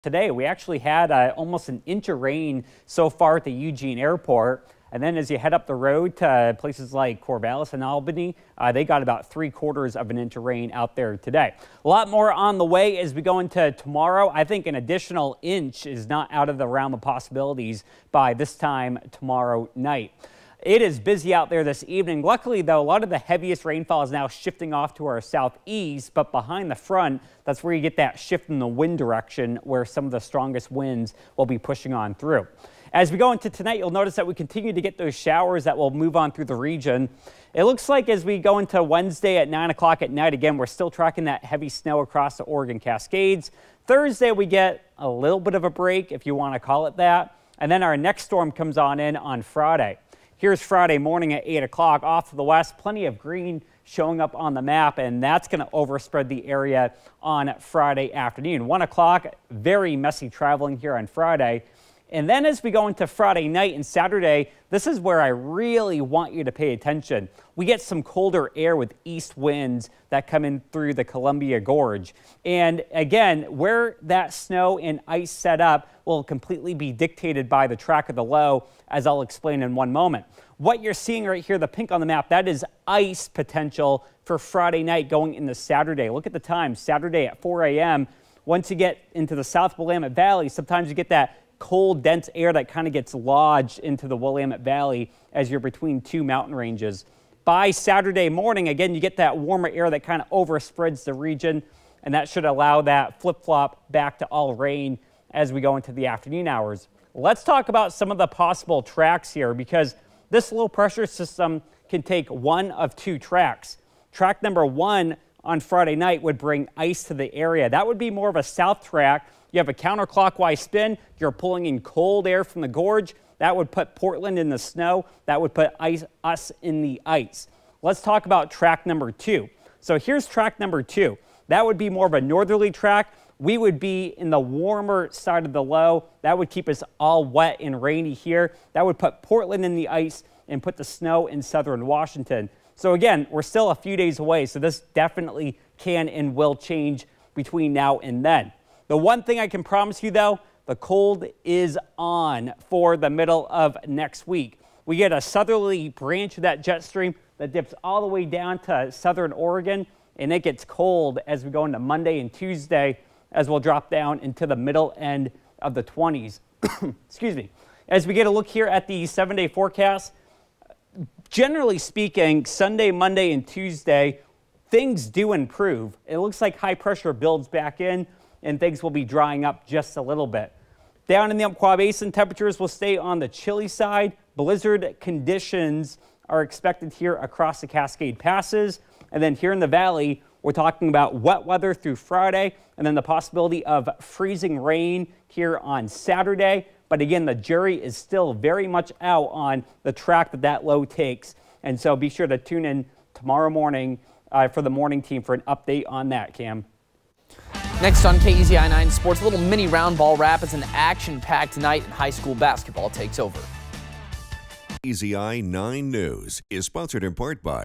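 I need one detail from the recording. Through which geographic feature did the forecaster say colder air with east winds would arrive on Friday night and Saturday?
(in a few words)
Columbia Gorge.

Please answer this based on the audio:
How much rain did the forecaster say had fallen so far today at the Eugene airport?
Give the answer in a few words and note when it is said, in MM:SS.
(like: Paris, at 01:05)
almost an inch, at 00:01.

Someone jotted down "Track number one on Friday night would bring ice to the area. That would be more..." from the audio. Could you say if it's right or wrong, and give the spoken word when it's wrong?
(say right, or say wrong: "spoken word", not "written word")
right.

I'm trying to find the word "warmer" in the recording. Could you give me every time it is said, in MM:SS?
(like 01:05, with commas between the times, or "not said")
01:39, 02:14.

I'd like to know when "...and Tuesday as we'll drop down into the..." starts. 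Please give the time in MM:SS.
02:42.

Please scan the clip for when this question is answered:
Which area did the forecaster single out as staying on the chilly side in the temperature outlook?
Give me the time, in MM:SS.
03:01.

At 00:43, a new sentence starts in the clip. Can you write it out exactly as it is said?
Thursday, we get a little bit of a break, if you want to call it that.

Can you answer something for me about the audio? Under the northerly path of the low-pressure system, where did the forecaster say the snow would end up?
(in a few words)
southern Washington.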